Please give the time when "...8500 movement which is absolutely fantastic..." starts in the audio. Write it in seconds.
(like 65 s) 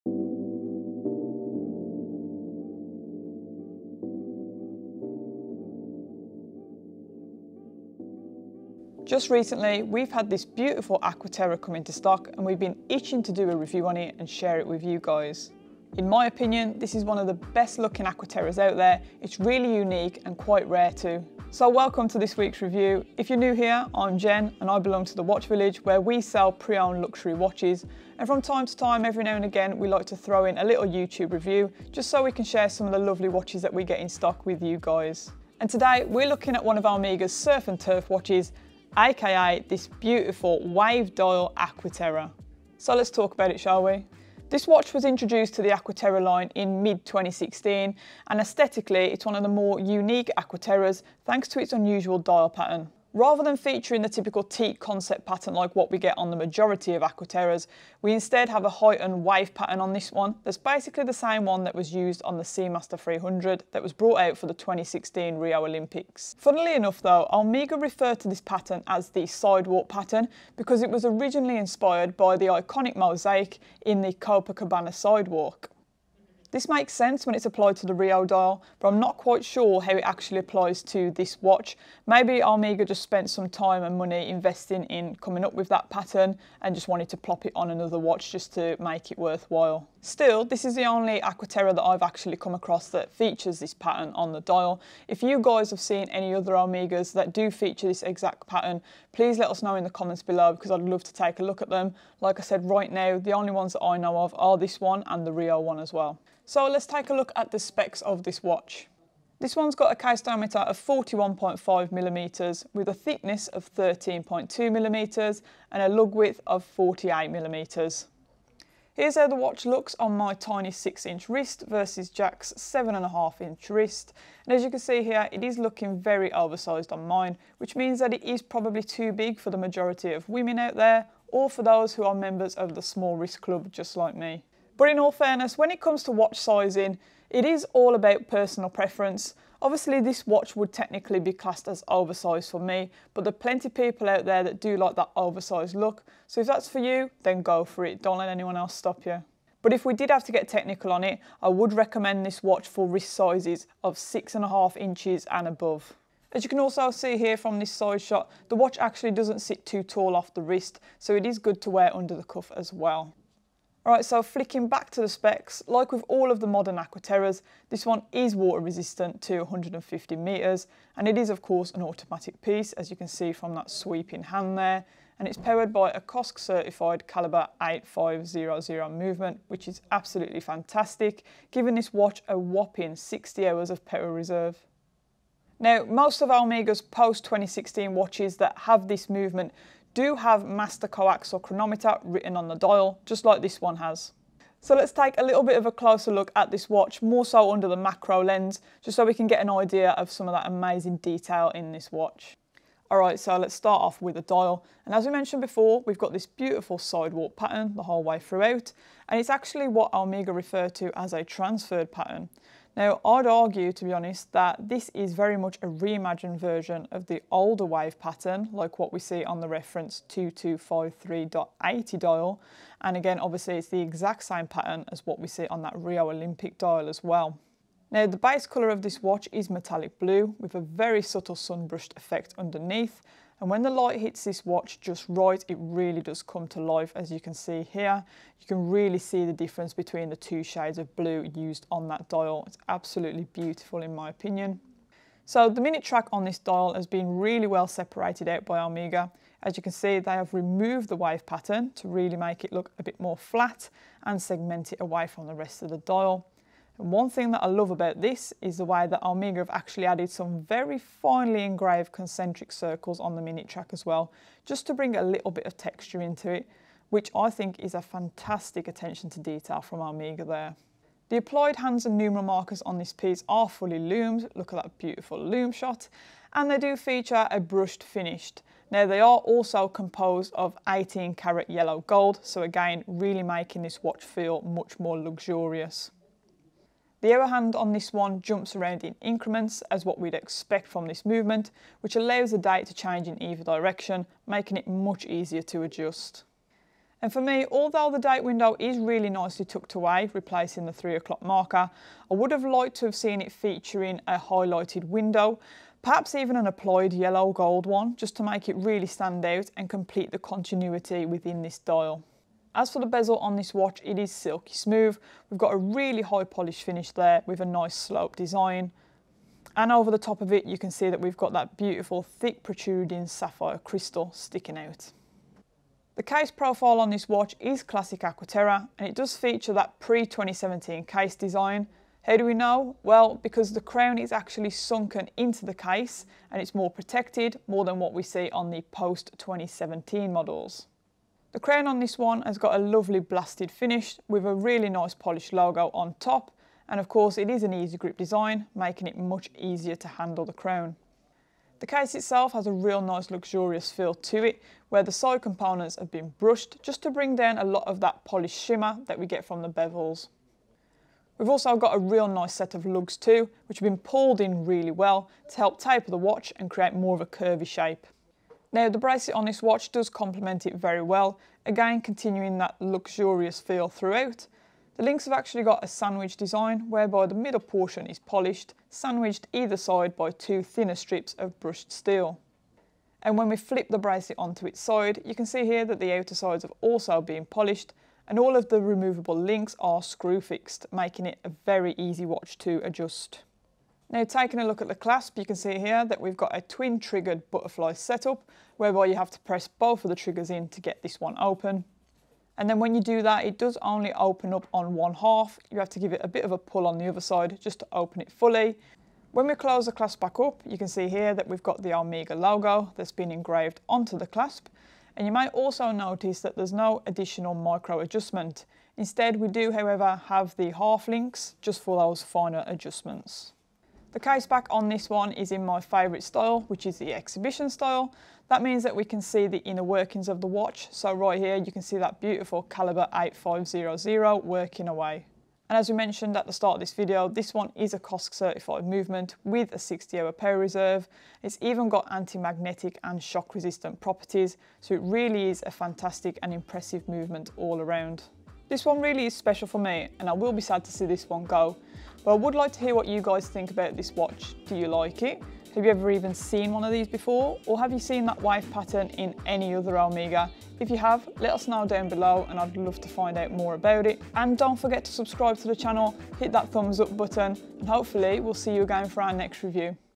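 177 s.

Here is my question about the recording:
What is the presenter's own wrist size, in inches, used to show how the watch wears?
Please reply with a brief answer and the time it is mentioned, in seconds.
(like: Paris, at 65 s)
6 inch, at 120 s.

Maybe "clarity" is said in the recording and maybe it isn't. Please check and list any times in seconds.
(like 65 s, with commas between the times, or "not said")
not said.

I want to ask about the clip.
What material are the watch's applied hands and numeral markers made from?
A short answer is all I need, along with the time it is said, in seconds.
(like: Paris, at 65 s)
18 karat yellow gold, at 280 s.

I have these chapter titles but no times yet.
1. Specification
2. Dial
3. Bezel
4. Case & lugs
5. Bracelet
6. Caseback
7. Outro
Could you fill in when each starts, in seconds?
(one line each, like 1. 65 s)
1. 106 s
2. 194 s
3. 313 s
4. 326 s
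5. 368 s
6. 423 s
7. 448 s.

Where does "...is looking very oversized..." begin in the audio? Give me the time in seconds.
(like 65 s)
125 s.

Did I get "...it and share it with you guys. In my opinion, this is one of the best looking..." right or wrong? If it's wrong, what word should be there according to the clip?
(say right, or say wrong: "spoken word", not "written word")
right.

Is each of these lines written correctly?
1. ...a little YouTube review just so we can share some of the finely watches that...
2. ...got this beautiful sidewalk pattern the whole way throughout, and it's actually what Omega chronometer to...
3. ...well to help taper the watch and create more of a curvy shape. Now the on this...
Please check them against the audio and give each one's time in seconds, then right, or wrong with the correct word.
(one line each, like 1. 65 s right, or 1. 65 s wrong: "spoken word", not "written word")
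1. 30 s wrong: "lovely", not "finely"
2. 205 s wrong: "refer", not "chronometer"
3. 364 s right.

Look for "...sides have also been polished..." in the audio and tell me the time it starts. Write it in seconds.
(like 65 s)
386 s.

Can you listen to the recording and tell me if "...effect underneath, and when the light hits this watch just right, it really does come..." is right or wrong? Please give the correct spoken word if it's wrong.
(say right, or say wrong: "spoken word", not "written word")
right.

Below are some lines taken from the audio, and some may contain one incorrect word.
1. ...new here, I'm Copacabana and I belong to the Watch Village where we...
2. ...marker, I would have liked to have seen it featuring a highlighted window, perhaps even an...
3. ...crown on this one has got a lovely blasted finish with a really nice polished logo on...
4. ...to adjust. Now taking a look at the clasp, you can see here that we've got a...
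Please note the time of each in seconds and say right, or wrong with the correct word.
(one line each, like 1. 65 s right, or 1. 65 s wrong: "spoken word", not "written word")
1. 23 s wrong: "Jen", not "Copacabana"
2. 301 s right
3. 341 s right
4. 392 s right.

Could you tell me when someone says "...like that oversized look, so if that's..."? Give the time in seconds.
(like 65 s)
144 s.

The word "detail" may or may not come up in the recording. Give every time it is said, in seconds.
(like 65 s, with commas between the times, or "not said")
200 s, 269 s.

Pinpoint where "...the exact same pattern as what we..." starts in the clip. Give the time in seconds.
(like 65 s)
223 s.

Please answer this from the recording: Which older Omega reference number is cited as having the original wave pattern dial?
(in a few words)
2253.80.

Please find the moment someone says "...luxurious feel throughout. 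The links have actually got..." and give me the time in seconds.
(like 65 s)
372 s.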